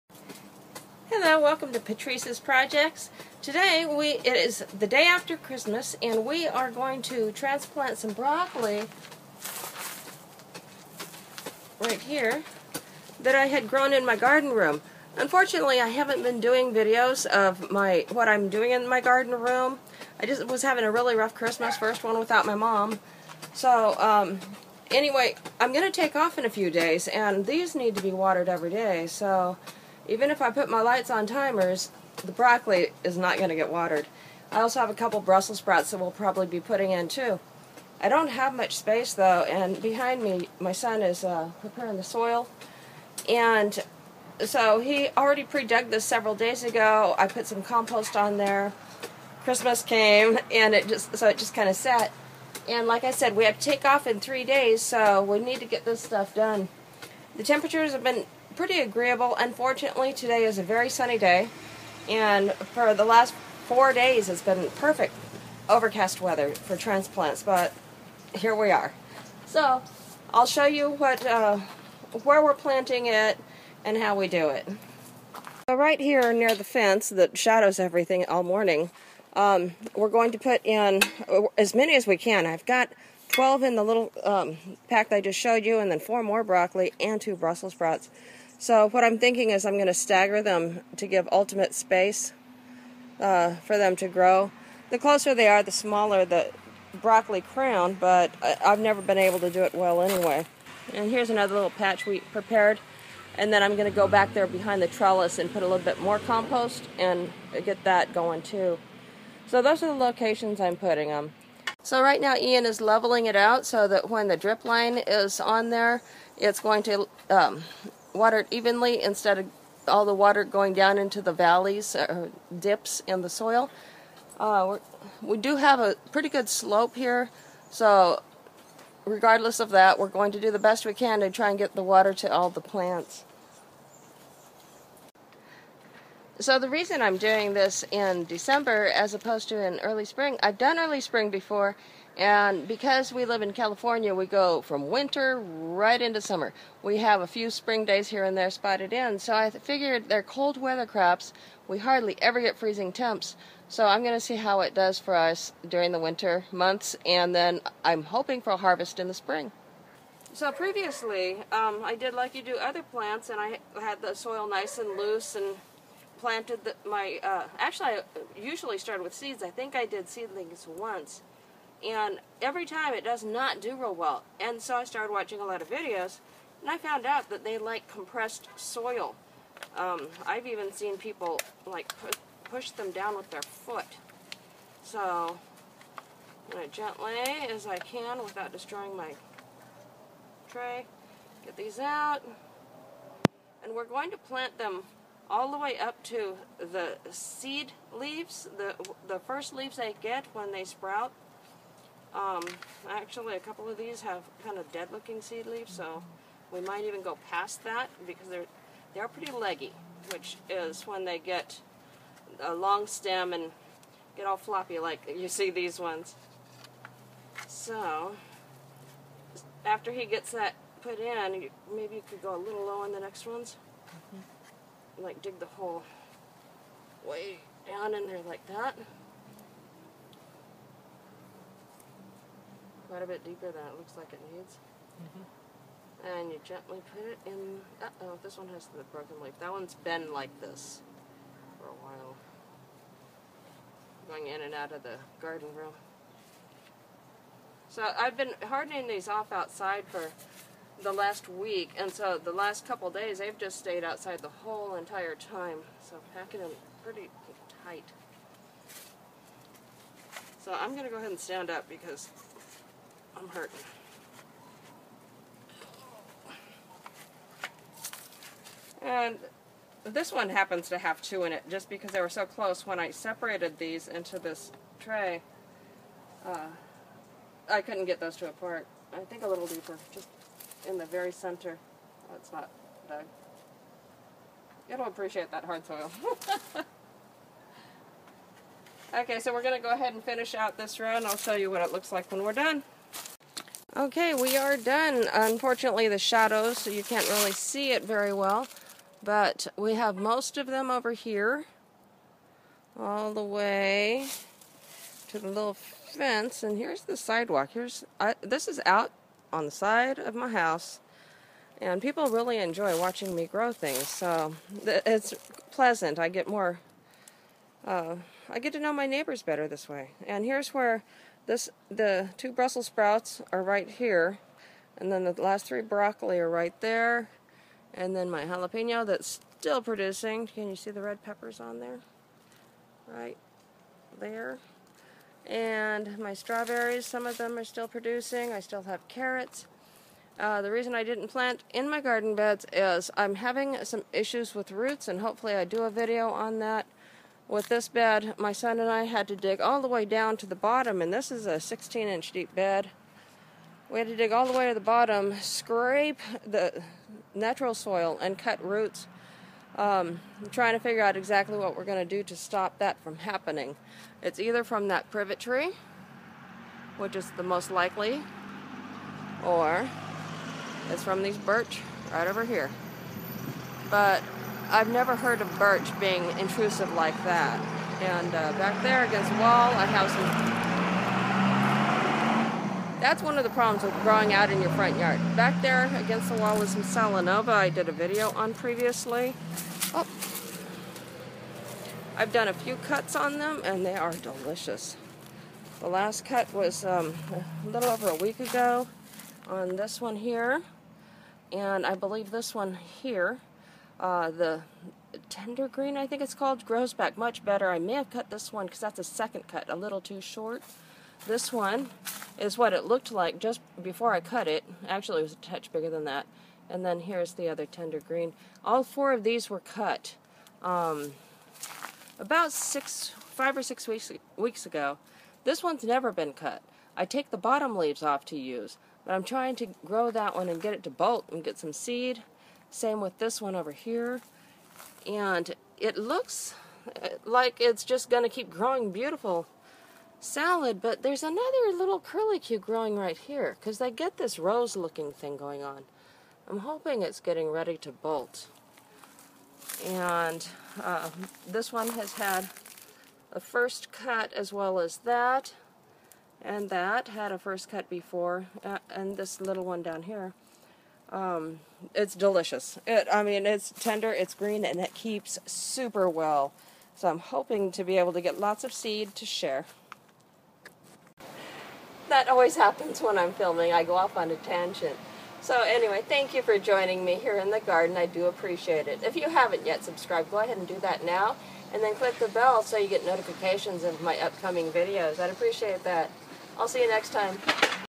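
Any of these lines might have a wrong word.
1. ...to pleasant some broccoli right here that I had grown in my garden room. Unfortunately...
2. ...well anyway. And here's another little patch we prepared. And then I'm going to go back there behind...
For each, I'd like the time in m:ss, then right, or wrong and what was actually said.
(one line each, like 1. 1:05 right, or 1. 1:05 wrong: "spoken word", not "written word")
1. 0:07 wrong: "transplant", not "pleasant"
2. 1:39 right.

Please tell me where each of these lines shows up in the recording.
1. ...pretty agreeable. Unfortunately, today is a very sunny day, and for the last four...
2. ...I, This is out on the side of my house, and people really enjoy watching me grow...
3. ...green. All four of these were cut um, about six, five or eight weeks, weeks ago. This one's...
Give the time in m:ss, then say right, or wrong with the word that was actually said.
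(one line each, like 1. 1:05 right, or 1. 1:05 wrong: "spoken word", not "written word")
1. 0:58 right
2. 5:07 right
3. 6:57 wrong: "six", not "eight".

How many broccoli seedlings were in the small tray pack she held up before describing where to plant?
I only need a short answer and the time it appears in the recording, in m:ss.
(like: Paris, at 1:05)
12, at 1:23.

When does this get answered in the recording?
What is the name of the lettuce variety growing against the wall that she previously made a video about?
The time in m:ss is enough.
6:26.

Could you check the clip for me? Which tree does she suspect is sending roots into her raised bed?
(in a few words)
Privet.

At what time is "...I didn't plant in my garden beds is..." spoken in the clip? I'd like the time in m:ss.
5:40.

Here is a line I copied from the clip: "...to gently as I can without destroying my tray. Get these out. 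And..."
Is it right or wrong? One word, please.
right.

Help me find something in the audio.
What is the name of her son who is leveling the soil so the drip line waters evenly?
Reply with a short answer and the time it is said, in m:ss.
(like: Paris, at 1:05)
Ian, at 1:52.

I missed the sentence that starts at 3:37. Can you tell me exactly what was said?
So after he gets that put in, maybe you could go a little low on the next ones, mm -hmm.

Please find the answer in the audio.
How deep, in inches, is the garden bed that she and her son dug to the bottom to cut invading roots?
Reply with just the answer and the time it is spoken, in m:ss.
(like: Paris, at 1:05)
16 inches, at 5:51.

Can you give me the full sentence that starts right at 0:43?
And so he already pre-dug this several days ago.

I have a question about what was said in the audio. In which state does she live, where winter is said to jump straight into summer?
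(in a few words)
California.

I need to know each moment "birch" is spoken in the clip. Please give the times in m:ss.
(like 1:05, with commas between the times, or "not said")
6:11, 6:15.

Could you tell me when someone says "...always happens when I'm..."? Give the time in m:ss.
7:52.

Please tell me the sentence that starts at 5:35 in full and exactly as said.
And my strawberries, some of them are still producing.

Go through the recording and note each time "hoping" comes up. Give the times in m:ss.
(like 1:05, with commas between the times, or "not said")
2:38, 7:26, 7:46.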